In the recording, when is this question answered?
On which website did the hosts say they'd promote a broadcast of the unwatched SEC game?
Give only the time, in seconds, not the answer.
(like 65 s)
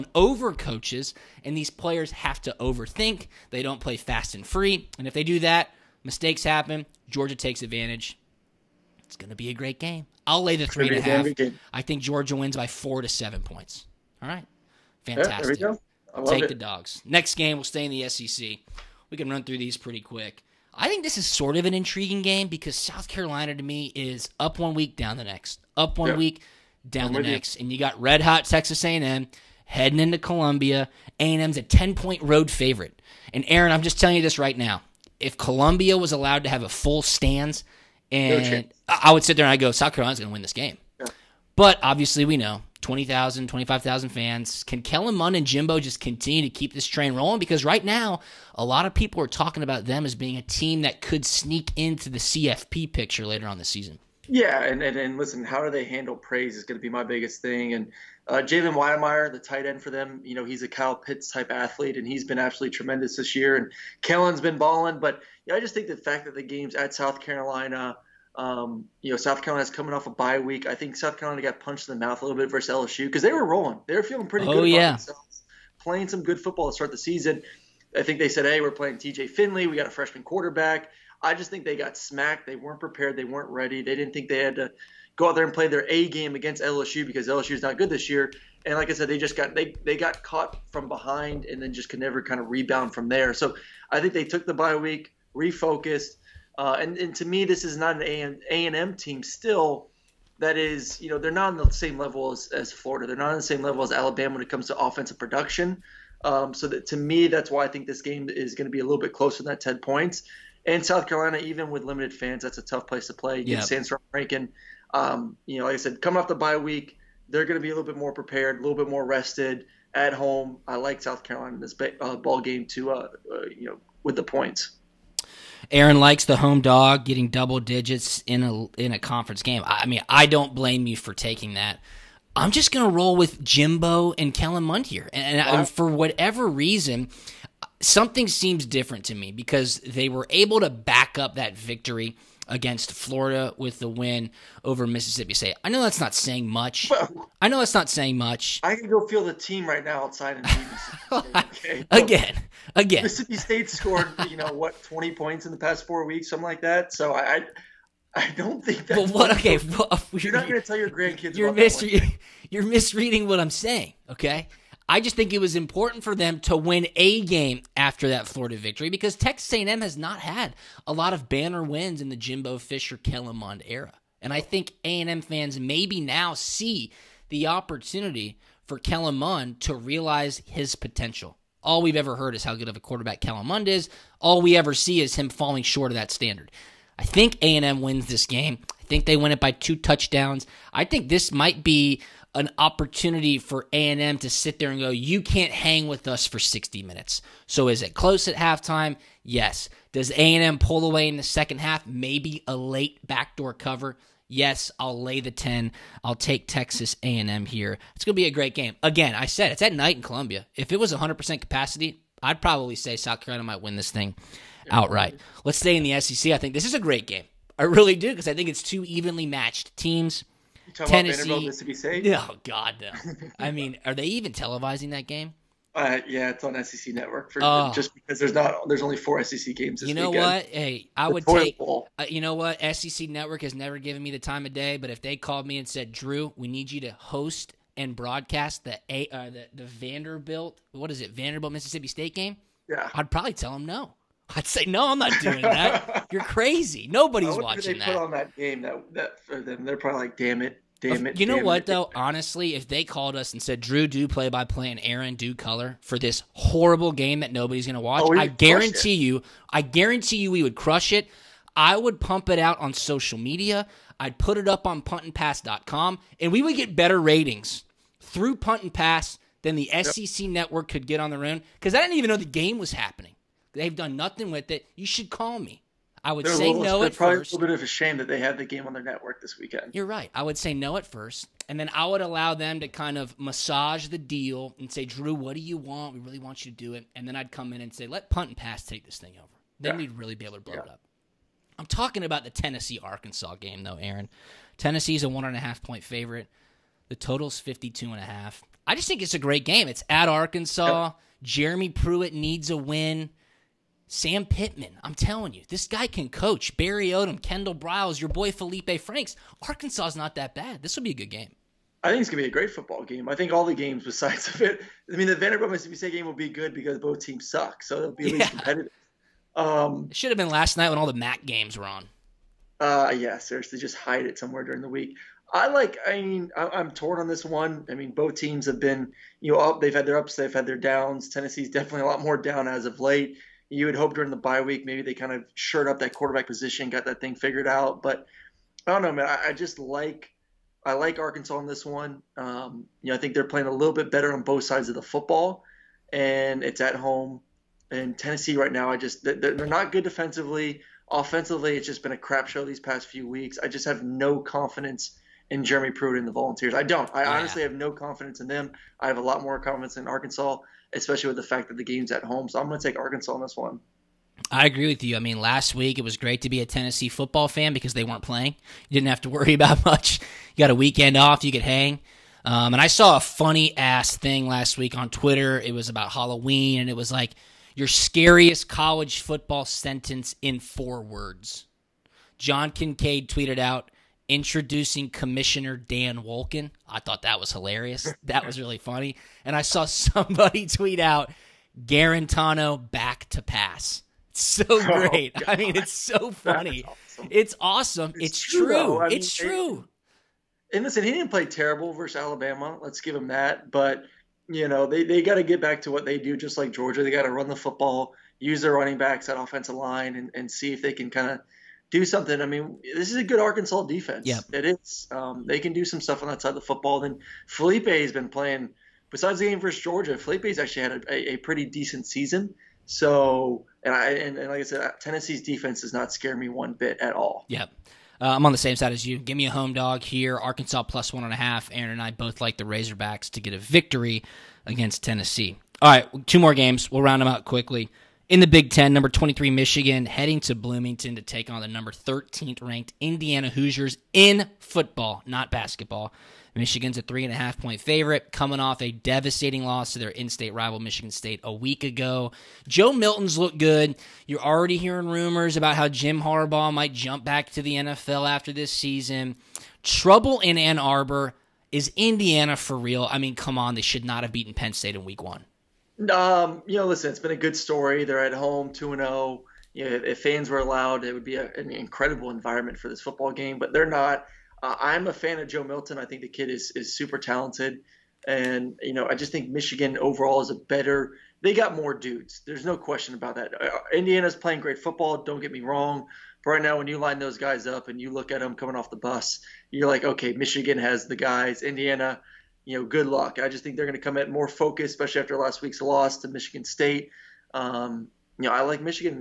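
264 s.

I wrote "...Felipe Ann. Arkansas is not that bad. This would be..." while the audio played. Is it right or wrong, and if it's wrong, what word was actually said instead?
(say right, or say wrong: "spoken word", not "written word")
wrong: "Franks", not "Ann".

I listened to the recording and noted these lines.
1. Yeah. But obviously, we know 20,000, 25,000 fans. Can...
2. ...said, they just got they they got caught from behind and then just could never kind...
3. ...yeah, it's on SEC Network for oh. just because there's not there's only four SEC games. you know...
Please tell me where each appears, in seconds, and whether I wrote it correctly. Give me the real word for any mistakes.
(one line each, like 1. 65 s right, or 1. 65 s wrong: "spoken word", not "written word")
1. 40 s right
2. 88 s right
3. 226 s right.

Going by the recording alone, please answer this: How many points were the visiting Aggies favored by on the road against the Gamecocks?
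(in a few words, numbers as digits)
10.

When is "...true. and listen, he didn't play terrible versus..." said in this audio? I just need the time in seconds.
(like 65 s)
399 s.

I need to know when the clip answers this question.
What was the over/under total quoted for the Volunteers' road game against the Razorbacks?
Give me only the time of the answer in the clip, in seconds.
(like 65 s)
297 s.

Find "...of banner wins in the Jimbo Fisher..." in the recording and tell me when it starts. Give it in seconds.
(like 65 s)
171 s.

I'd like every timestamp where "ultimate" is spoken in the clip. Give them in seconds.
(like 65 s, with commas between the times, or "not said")
not said.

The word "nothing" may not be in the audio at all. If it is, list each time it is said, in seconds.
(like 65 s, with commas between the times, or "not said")
273 s.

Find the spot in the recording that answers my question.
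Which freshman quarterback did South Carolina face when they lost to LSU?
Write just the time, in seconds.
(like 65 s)
78 s.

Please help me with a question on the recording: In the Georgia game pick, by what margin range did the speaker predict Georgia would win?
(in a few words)
4 to 7 points.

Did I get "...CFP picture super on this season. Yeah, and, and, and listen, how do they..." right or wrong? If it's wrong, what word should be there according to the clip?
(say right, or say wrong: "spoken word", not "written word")
wrong: "later", not "super".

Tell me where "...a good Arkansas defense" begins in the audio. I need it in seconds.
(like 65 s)
412 s.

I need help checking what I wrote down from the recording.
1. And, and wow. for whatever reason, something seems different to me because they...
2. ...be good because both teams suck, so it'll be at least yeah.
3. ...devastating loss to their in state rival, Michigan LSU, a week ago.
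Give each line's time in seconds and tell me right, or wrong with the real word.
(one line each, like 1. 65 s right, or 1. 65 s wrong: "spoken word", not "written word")
1. 135 s right
2. 316 s right
3. 448 s wrong: "State", not "LSU".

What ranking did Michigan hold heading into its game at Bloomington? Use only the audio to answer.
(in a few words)
23.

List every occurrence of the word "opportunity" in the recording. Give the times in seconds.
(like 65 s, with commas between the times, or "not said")
177 s, 192 s.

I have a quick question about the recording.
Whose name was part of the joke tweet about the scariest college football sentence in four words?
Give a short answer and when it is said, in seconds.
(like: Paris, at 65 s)
Dan Wolken, at 385 s.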